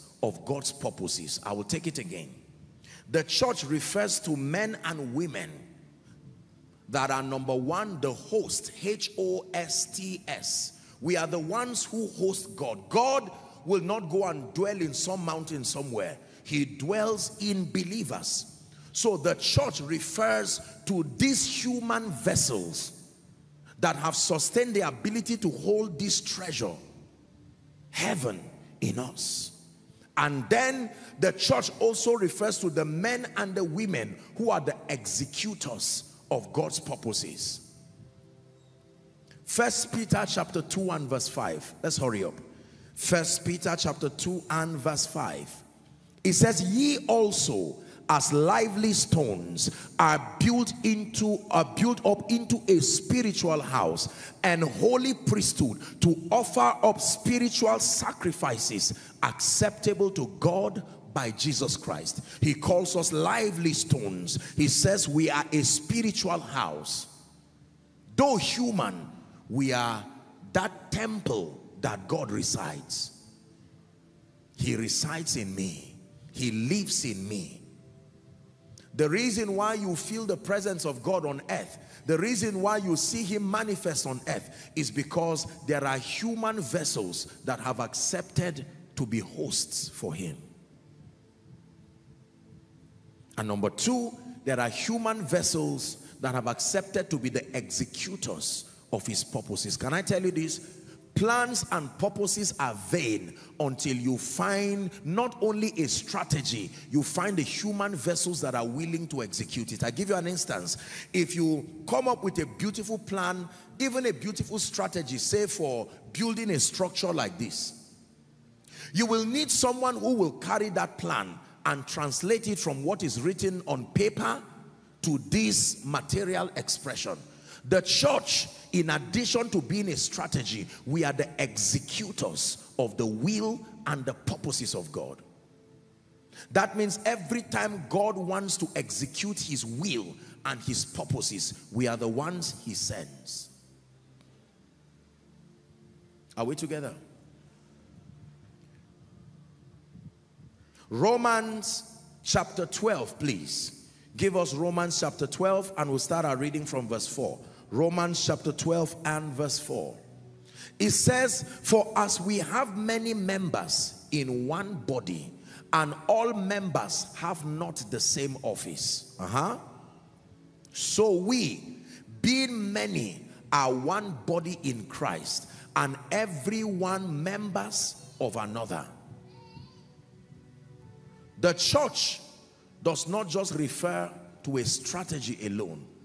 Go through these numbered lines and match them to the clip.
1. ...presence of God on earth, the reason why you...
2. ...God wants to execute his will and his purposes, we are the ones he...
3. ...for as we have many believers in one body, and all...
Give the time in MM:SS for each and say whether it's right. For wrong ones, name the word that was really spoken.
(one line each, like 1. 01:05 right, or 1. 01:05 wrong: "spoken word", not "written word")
1. 01:20 right
2. 02:17 right
3. 02:41 wrong: "members", not "believers".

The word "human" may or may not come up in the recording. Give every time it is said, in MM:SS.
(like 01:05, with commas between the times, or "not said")
00:21, 01:08, 01:25, 01:34, 01:47.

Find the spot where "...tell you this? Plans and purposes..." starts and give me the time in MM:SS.
01:40.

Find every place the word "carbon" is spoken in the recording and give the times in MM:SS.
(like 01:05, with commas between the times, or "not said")
not said.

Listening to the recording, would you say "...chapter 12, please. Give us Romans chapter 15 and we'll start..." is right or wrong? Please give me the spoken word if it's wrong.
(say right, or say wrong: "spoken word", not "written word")
wrong: "12", not "15".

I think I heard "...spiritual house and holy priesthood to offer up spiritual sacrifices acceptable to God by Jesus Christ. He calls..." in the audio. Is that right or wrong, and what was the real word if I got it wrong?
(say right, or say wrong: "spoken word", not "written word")
right.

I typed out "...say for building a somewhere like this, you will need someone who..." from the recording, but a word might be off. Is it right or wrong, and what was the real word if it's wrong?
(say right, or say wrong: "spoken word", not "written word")
wrong: "structure", not "somewhere".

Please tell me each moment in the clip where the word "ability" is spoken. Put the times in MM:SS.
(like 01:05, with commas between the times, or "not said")
00:24.